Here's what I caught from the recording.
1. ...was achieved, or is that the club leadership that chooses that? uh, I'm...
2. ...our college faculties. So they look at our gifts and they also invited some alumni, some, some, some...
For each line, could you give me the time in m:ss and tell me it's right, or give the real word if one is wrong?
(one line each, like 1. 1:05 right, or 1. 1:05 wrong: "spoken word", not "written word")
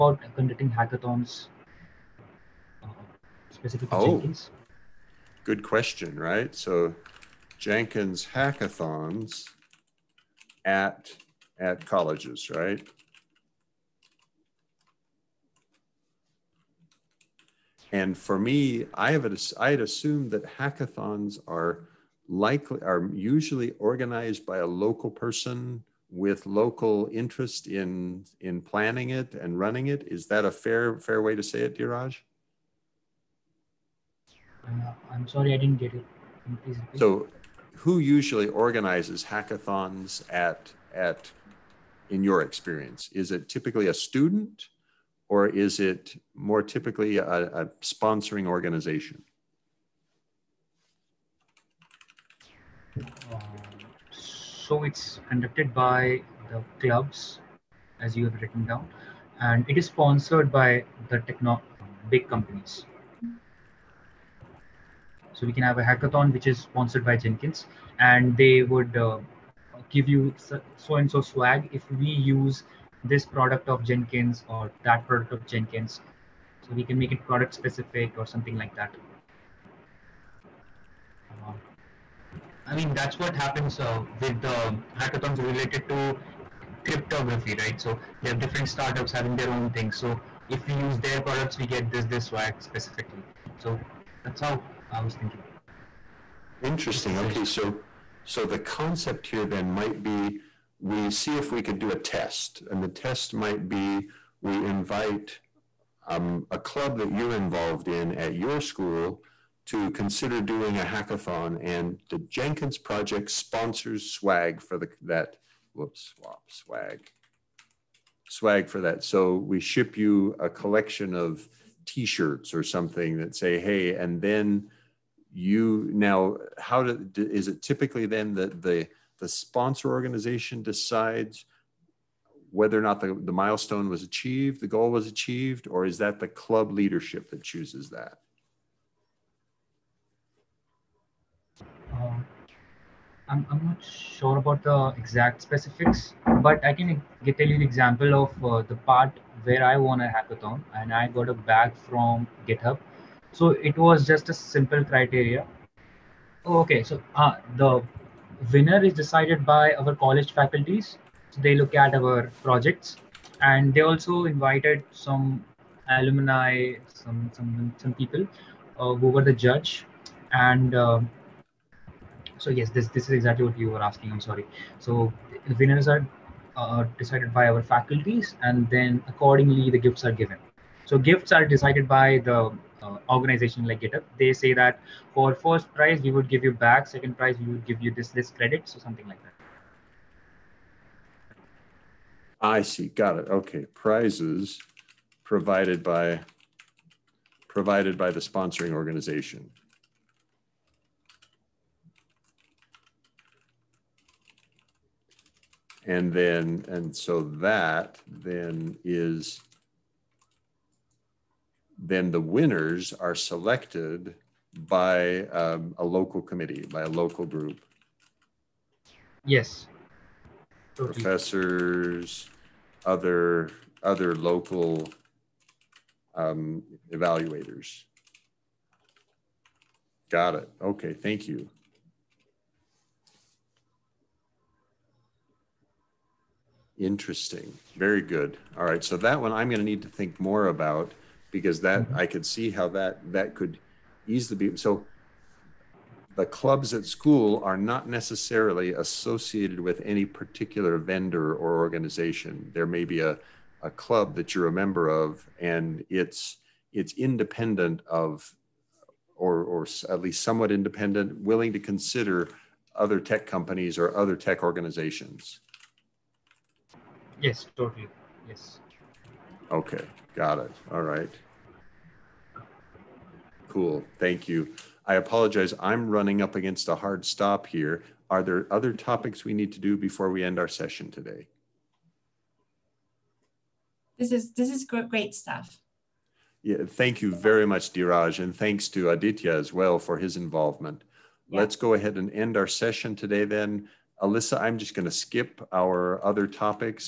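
1. 2:14 right
2. 2:39 wrong: "projects", not "gifts".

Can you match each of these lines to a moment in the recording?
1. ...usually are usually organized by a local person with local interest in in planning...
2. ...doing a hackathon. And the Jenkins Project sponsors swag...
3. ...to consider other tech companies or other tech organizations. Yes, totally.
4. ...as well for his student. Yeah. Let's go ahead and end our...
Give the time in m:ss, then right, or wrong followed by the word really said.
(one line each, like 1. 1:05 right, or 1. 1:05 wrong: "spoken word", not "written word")
1. 0:22 wrong: "likely", not "usually"
2. 1:50 right
3. 4:21 right
4. 4:49 wrong: "involvement", not "student".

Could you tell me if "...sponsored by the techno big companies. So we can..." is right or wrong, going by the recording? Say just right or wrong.
right.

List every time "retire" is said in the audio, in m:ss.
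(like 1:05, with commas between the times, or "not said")
not said.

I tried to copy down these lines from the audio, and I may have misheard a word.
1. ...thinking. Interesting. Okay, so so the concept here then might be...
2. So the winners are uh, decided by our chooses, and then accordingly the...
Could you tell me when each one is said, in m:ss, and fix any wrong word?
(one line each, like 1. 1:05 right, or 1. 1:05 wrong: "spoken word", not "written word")
1. 1:35 right
2. 2:54 wrong: "faculties", not "chooses".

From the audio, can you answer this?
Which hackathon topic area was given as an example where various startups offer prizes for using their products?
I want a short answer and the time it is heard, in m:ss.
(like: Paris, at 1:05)
Cryptography, at 1:26.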